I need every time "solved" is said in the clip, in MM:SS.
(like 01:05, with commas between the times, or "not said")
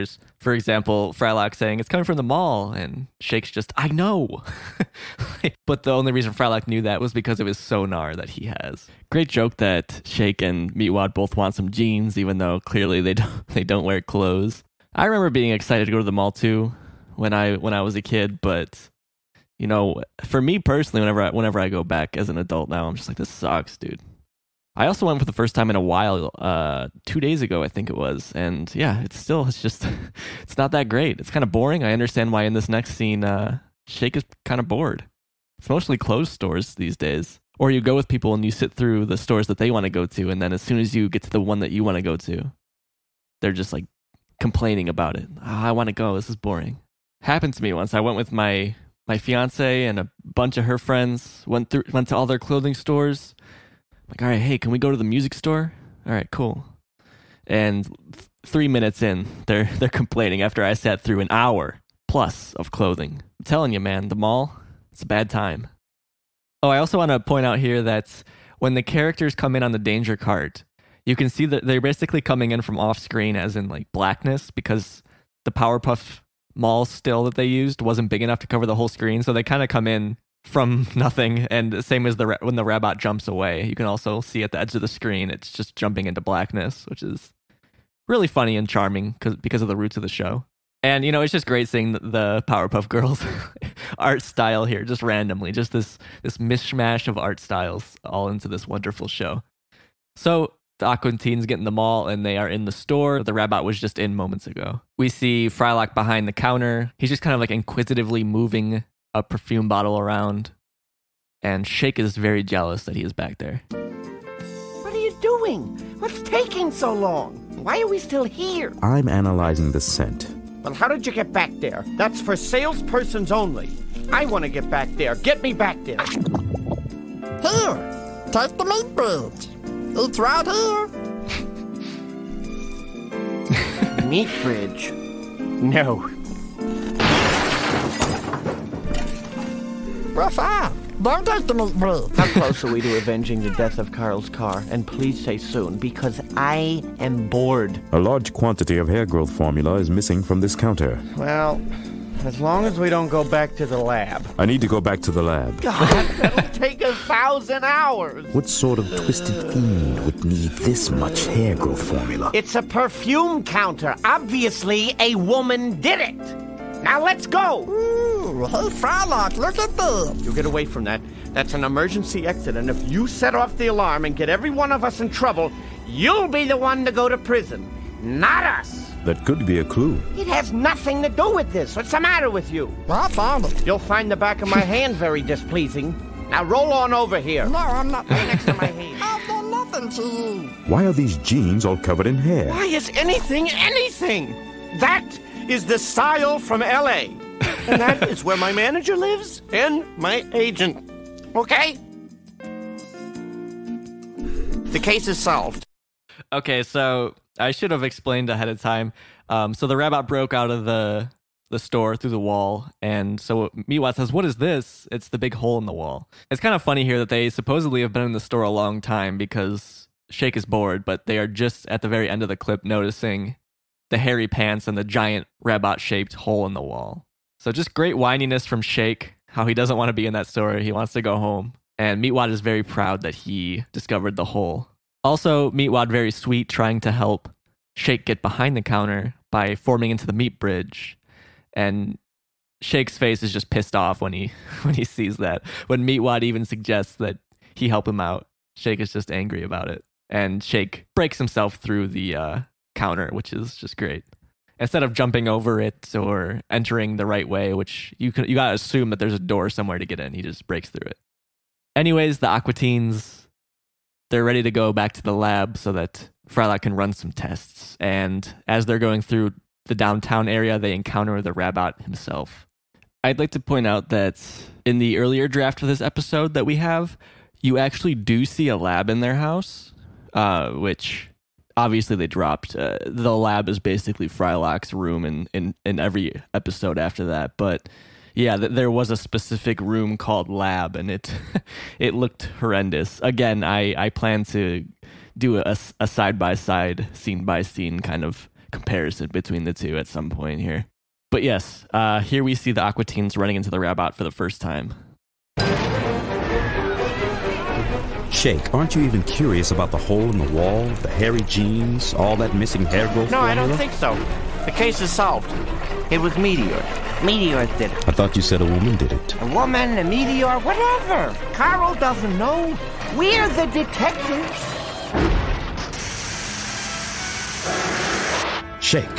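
03:25, 05:14.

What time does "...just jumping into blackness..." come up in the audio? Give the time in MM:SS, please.
01:25.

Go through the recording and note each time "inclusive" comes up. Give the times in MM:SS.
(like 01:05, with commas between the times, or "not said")
not said.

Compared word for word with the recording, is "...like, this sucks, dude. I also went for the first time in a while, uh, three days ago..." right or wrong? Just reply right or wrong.
wrong.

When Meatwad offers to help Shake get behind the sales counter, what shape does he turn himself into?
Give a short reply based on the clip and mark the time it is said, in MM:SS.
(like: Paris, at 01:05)
meat bridge, at 04:00.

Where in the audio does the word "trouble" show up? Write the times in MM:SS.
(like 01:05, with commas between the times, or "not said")
02:55.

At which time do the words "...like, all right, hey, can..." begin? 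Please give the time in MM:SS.
00:54.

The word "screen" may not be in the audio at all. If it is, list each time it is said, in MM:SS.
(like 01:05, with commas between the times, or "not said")
01:12, 01:18, 01:24.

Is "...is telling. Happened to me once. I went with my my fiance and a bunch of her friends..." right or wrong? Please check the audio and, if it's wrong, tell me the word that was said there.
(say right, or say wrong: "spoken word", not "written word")
wrong: "boring", not "telling".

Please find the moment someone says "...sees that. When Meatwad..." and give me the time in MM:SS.
04:04.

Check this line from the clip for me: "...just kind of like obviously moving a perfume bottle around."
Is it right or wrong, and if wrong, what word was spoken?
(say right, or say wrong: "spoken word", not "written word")
wrong: "inquisitively", not "obviously".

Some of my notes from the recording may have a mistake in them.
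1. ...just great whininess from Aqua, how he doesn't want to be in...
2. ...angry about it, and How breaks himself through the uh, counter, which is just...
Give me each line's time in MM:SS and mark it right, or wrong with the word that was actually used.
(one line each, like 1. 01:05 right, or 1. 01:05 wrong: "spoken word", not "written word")
1. 03:47 wrong: "Shake", not "Aqua"
2. 04:09 wrong: "Shake", not "How".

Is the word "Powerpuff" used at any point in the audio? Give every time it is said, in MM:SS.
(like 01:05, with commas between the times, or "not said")
01:15, 01:32.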